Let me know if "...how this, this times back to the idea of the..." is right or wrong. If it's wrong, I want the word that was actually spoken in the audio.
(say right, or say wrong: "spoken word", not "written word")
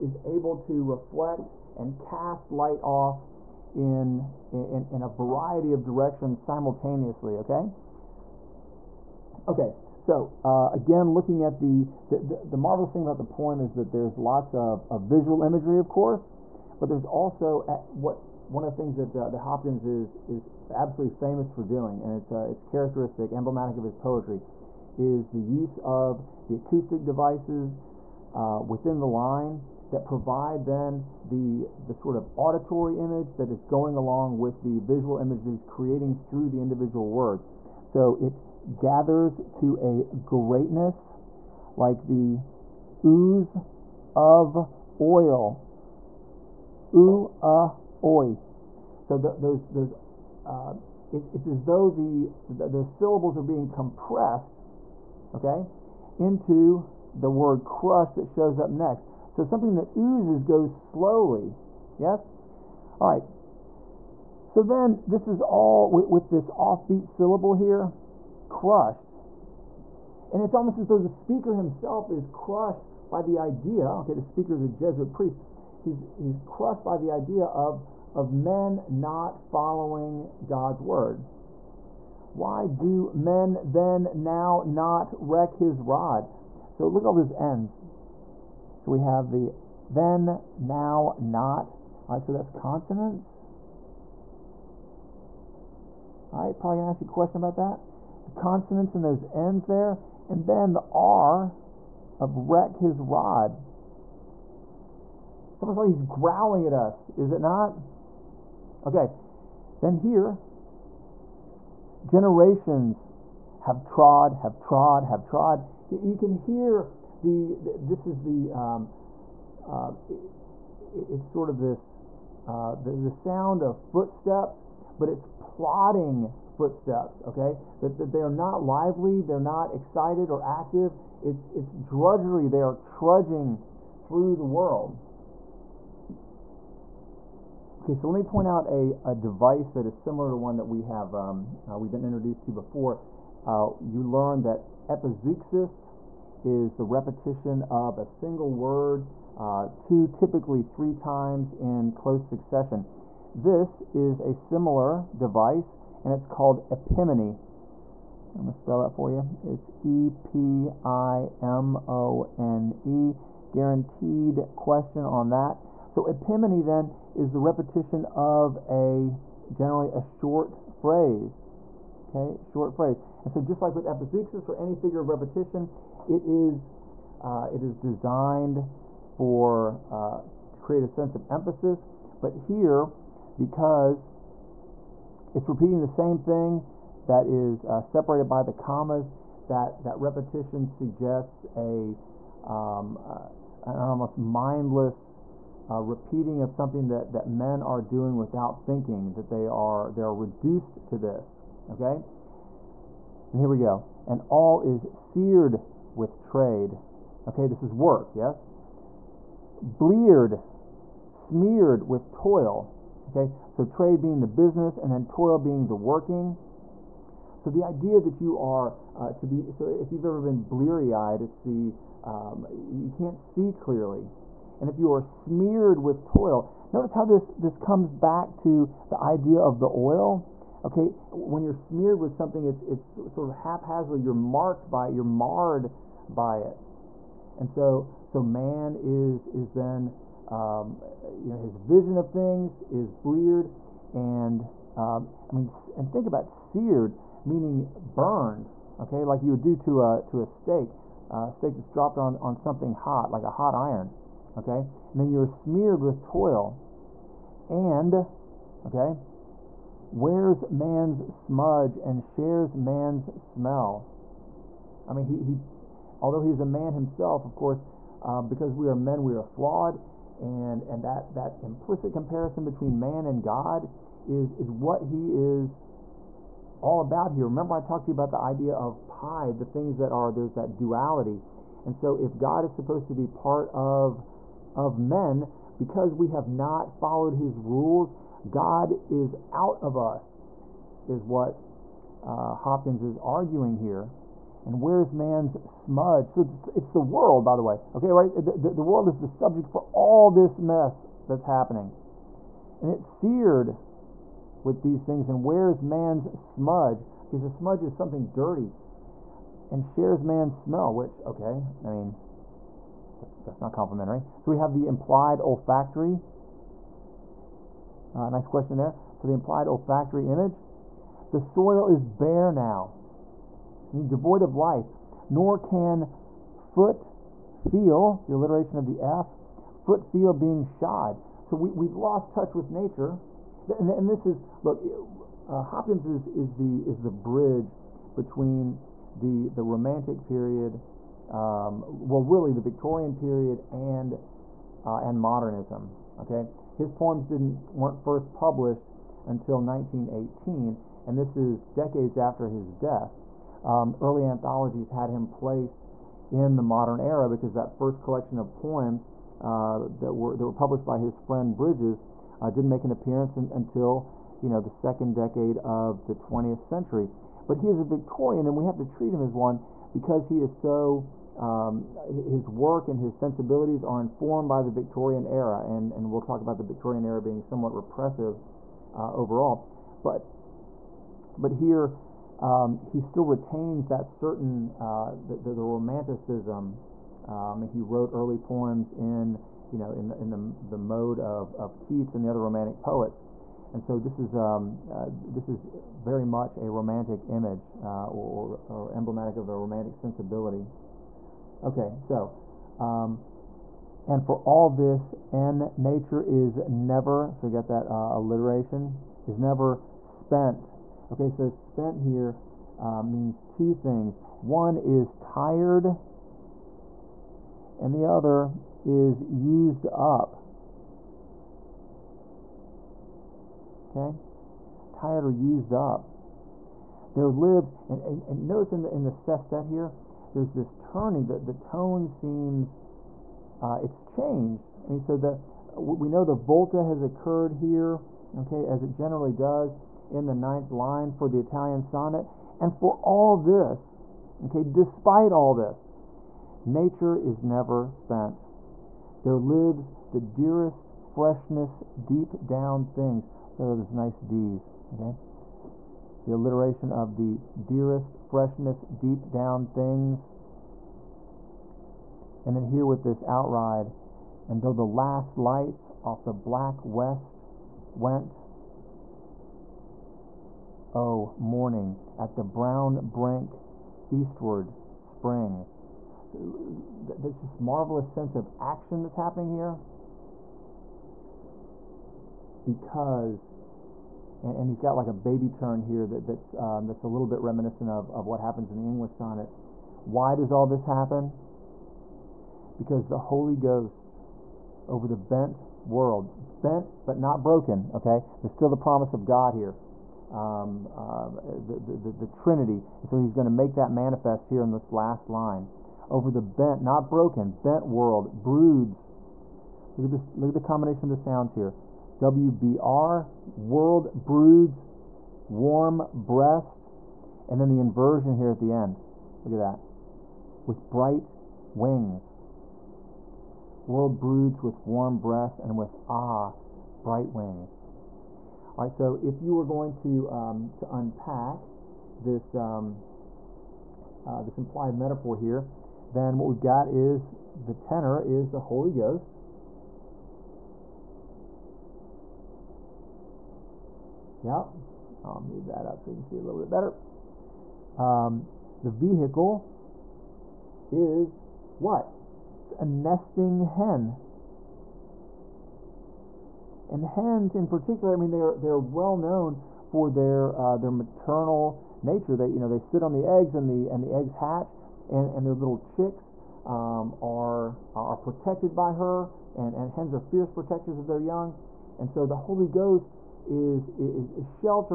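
wrong: "comes", not "times".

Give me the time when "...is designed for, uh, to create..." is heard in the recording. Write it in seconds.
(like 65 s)
177 s.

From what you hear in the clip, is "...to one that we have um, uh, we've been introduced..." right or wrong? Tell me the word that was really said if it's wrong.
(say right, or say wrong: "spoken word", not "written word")
right.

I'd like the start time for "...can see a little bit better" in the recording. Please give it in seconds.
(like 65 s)
545 s.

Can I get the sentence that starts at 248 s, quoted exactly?
Okay, like you would do to a to a steak, a steak that's dropped on on something hot, like a hot iron.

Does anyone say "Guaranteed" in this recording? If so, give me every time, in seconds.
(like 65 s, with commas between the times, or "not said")
163 s.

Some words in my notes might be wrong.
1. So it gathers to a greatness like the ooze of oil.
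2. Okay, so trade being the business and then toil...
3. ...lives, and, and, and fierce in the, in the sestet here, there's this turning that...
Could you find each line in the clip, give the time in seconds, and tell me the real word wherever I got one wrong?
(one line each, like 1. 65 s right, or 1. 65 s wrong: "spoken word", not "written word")
1. 37 s right
2. 213 s right
3. 427 s wrong: "notice", not "fierce".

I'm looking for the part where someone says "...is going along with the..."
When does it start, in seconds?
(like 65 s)
33 s.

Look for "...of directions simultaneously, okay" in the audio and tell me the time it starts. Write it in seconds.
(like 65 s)
5 s.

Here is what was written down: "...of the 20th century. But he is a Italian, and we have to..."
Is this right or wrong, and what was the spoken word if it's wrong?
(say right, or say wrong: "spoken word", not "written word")
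wrong: "Victorian", not "Italian".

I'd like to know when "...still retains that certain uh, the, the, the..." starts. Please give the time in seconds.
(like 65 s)
382 s.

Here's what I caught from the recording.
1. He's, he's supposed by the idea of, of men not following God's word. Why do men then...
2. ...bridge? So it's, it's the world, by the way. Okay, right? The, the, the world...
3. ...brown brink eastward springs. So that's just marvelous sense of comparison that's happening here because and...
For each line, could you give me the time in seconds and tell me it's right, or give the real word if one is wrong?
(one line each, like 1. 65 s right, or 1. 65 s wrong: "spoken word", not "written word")
1. 75 s wrong: "crushed", not "supposed"
2. 295 s wrong: "smudge", not "bridge"
3. 472 s wrong: "action", not "comparison".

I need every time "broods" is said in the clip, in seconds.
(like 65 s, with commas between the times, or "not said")
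508 s, 514 s, 523 s.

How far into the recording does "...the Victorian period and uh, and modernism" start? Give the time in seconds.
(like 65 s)
342 s.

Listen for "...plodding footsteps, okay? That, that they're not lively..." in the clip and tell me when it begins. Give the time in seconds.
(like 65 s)
125 s.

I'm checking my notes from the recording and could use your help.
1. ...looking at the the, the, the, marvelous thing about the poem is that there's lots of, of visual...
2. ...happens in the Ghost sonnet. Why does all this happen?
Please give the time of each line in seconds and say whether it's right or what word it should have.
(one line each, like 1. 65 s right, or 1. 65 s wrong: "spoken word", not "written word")
1. 11 s right
2. 488 s wrong: "English", not "Ghost".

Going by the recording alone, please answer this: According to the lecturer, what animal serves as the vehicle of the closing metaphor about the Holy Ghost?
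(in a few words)
a nesting hen.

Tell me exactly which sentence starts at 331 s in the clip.
So we, we've lost touch with nature.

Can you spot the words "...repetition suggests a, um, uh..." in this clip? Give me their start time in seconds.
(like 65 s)
190 s.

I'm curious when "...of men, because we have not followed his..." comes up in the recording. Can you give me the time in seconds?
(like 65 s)
284 s.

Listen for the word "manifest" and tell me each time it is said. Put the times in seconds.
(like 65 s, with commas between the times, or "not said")
503 s.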